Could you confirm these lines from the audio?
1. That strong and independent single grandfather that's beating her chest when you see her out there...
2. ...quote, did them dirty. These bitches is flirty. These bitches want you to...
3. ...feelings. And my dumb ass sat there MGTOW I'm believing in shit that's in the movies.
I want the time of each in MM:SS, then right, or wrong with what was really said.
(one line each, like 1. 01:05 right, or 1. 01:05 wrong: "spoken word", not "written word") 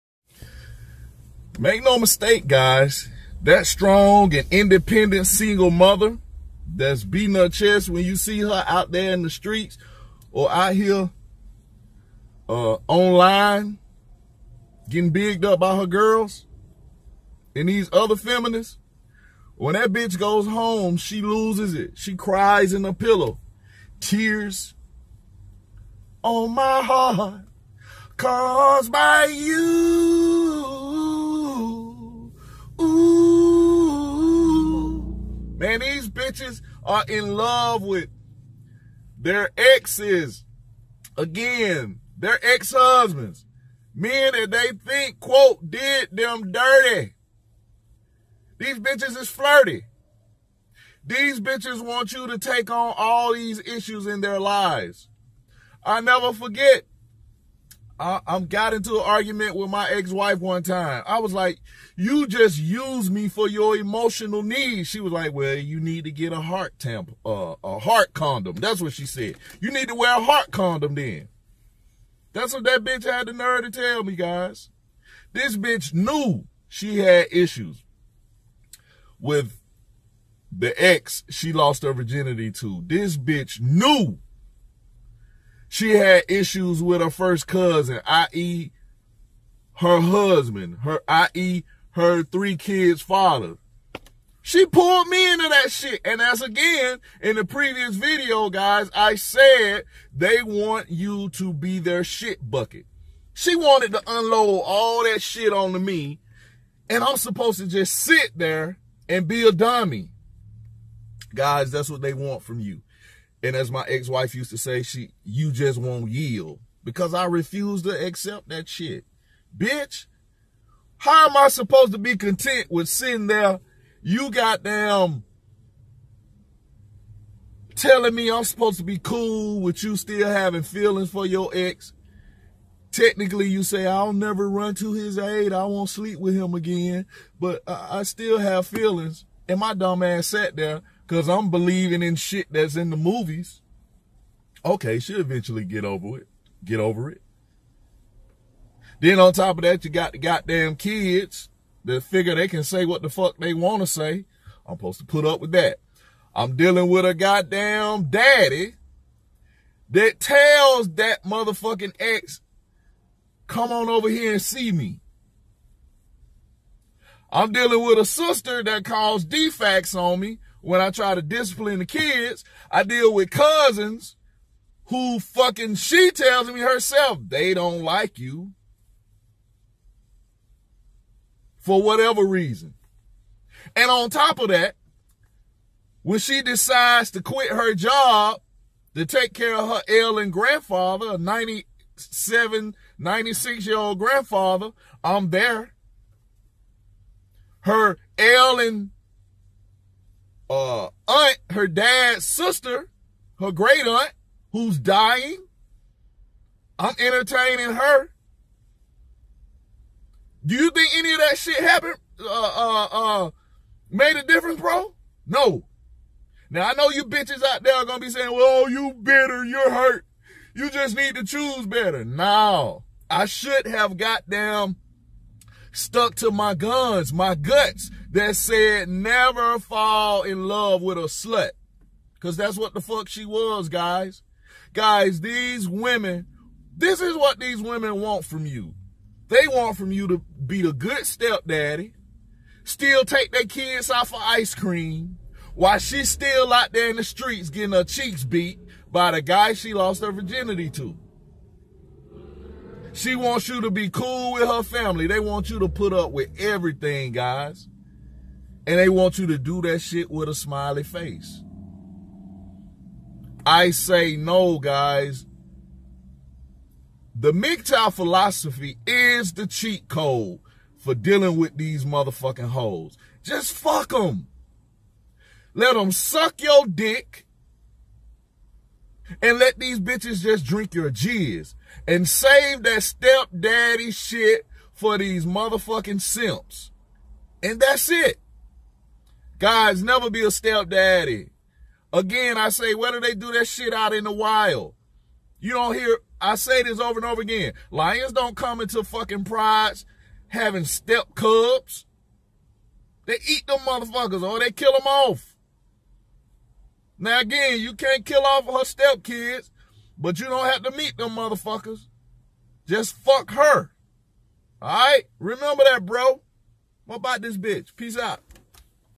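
1. 00:03 wrong: "mother", not "grandfather"
2. 00:45 right
3. 02:18 wrong: "Cause", not "MGTOW".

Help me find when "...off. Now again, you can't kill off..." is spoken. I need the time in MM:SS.
05:04.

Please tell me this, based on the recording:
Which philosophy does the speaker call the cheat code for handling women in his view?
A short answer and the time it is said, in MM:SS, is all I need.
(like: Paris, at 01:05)
MGTOW, at 04:27.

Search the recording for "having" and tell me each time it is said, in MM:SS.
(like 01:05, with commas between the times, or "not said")
02:10, 05:00.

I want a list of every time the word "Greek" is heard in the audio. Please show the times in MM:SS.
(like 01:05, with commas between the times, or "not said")
not said.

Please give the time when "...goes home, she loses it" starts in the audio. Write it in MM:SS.
00:20.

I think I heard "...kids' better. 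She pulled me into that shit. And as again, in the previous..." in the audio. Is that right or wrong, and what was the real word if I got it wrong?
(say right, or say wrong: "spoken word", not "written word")
wrong: "father", not "better".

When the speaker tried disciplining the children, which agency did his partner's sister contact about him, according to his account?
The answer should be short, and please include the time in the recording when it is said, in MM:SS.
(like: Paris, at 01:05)
DFCS, at 02:49.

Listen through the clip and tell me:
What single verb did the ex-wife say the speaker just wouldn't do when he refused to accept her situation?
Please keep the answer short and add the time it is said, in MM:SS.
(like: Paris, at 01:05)
yield, at 01:56.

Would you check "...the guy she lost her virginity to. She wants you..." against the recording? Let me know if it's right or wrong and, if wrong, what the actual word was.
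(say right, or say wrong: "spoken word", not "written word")
right.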